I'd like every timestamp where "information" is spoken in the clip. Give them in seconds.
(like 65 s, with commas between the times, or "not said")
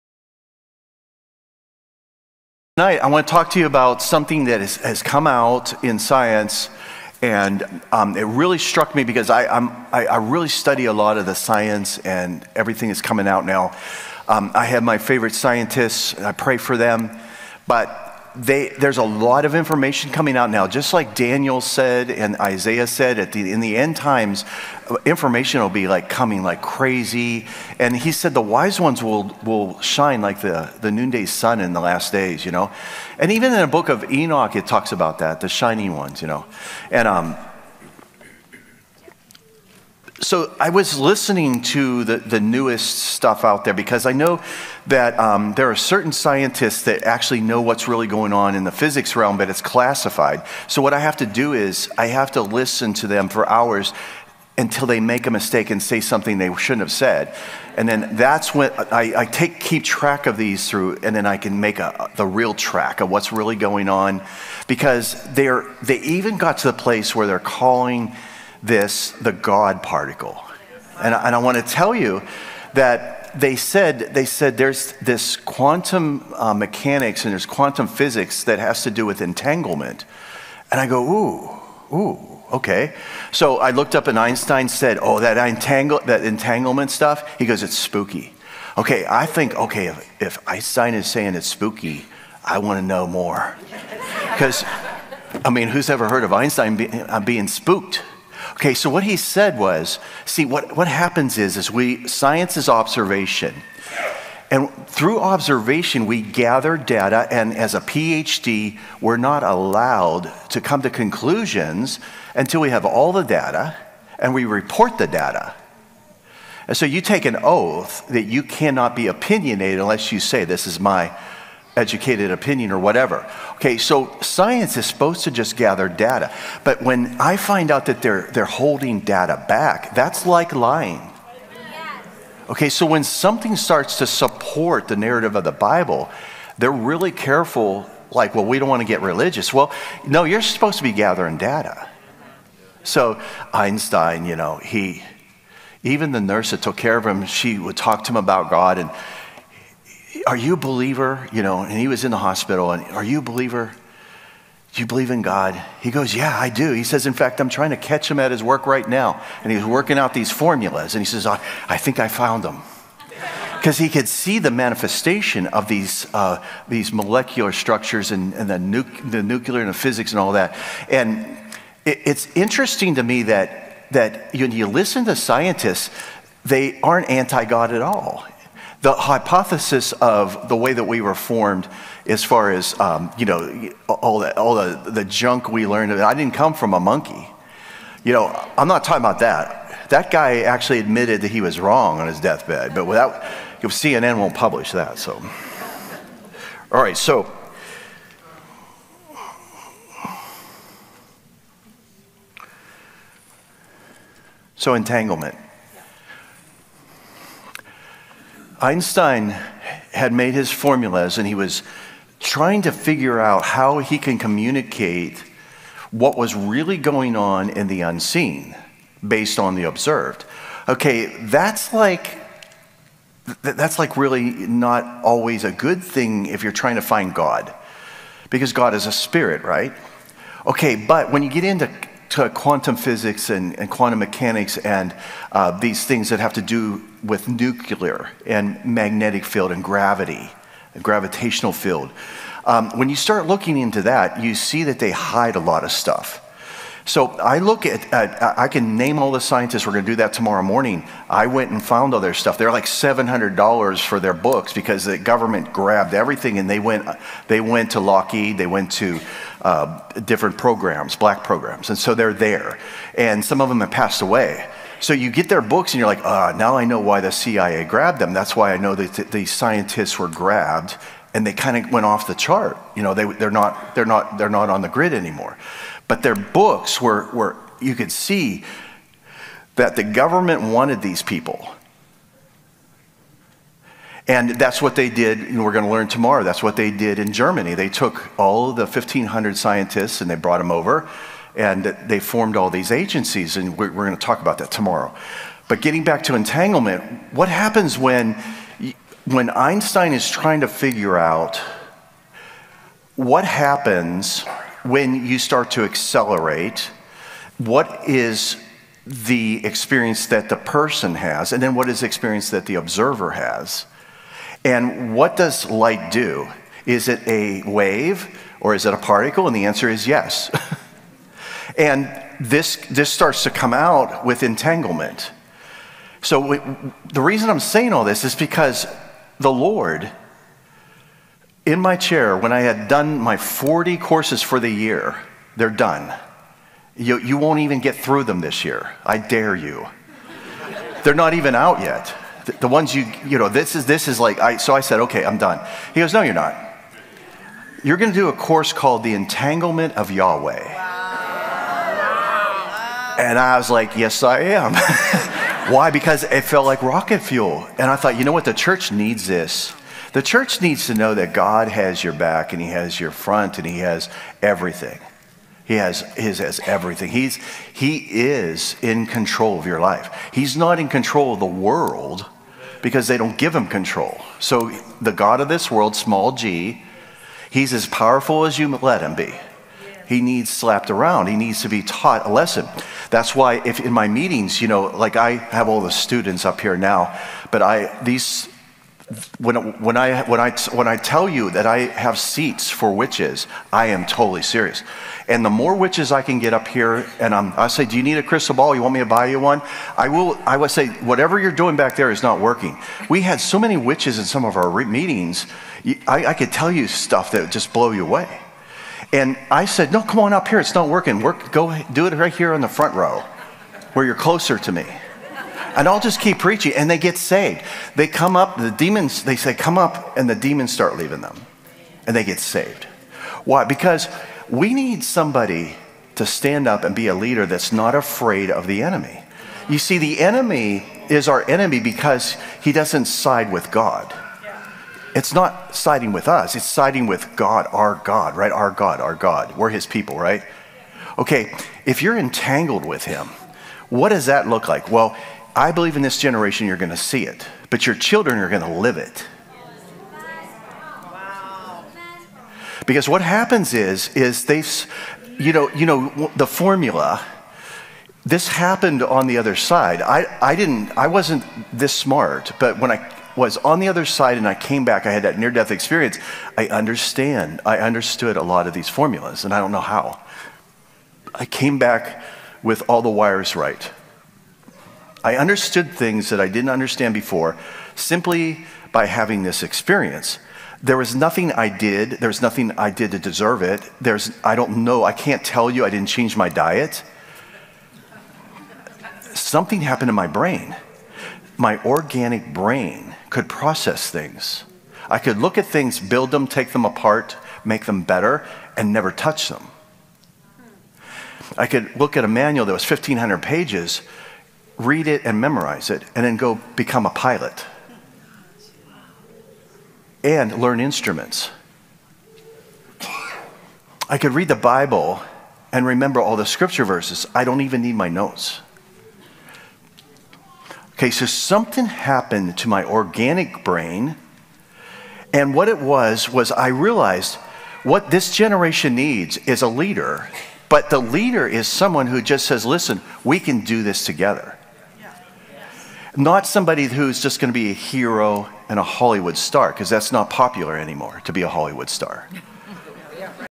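19 s, 25 s.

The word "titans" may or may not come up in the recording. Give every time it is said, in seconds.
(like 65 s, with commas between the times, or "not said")
not said.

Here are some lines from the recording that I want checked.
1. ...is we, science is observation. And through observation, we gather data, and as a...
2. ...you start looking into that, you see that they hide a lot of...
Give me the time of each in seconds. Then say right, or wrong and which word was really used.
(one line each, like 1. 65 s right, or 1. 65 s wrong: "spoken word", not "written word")
1. 101 s right
2. 242 s right.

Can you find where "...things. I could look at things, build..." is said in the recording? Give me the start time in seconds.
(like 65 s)
493 s.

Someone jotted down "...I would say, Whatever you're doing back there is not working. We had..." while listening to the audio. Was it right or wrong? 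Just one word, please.
right.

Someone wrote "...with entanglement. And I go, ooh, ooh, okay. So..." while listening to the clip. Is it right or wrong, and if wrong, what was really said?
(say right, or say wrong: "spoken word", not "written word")
right.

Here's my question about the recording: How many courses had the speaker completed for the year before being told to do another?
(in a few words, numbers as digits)
40.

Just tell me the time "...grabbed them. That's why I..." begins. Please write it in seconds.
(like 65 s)
267 s.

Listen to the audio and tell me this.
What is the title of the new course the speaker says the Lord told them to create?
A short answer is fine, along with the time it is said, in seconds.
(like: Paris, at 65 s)
The Entanglement of Yahweh, at 348 s.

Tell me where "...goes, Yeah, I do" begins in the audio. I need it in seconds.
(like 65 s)
155 s.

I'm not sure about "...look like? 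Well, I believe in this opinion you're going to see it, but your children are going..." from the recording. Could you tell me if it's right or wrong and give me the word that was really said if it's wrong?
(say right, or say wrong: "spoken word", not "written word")
wrong: "generation", not "opinion".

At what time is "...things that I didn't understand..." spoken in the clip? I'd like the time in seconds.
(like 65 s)
475 s.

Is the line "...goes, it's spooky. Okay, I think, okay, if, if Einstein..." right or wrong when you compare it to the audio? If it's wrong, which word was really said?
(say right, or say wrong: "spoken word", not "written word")
right.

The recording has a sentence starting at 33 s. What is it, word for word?
And even in the book of Enoch, it talks about that, the shining ones, you know.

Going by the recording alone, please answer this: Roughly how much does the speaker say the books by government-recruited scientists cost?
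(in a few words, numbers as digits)
$700.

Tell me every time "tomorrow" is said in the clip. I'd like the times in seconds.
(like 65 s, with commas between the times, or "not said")
250 s, 285 s, 294 s.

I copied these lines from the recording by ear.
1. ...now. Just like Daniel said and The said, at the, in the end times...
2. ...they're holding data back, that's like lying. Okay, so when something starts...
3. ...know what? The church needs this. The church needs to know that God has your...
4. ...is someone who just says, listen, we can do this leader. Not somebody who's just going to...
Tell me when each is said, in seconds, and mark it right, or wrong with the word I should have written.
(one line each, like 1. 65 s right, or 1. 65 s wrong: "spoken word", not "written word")
1. 20 s wrong: "Isaiah", not "The"
2. 128 s right
3. 358 s right
4. 531 s wrong: "together", not "leader".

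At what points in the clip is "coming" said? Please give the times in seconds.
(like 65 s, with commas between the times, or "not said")
13 s, 20 s, 26 s.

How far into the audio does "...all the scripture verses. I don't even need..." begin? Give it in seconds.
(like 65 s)
516 s.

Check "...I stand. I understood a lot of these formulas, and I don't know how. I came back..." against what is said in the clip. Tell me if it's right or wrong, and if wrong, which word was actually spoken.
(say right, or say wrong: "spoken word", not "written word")
wrong: "understand", not "stand".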